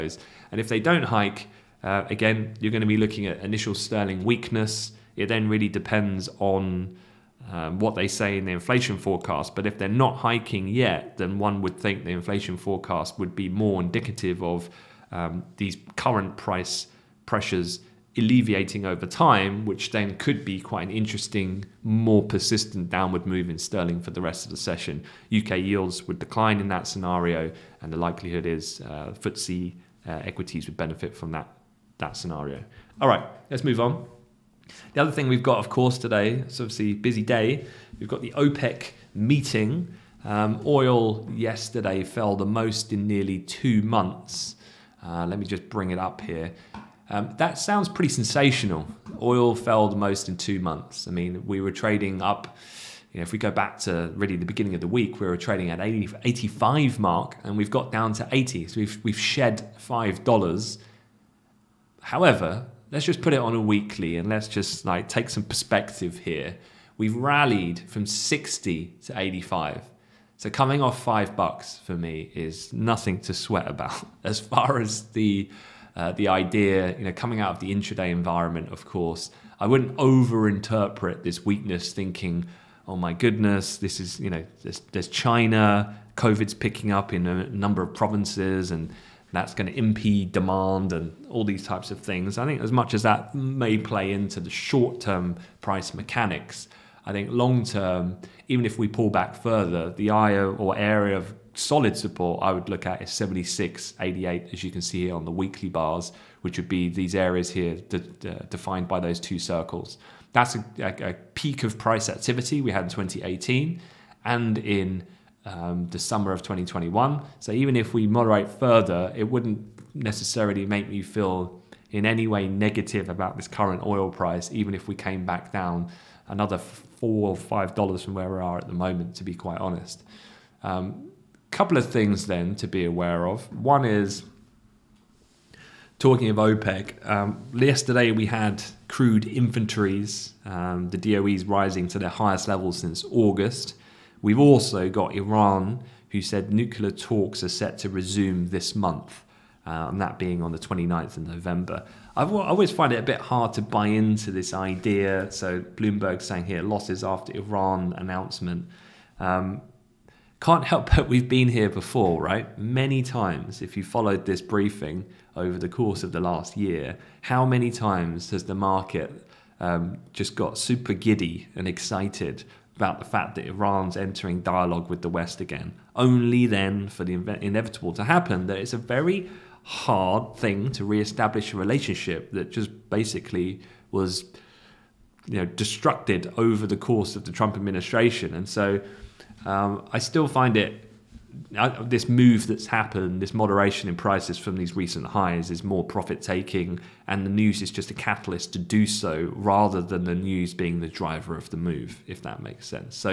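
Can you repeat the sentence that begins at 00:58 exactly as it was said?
So we've we've shed five dollars.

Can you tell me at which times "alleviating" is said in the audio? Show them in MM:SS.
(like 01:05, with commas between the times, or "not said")
00:18.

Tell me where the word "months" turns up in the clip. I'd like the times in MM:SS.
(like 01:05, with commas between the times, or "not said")
00:43, 00:50, 02:28.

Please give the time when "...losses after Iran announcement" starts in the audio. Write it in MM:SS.
02:36.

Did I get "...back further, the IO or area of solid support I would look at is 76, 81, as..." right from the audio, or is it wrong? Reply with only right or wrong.
wrong.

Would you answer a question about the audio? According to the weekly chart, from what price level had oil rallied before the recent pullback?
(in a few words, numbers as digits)
60.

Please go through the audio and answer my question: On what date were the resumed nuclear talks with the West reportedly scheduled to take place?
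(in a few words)
29th of November.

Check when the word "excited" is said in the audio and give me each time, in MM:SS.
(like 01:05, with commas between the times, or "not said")
02:51.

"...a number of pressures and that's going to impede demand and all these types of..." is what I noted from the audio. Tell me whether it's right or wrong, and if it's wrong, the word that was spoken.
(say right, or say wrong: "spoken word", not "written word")
wrong: "provinces", not "pressures".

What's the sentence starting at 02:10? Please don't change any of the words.
Um, couple of things then to be aware of.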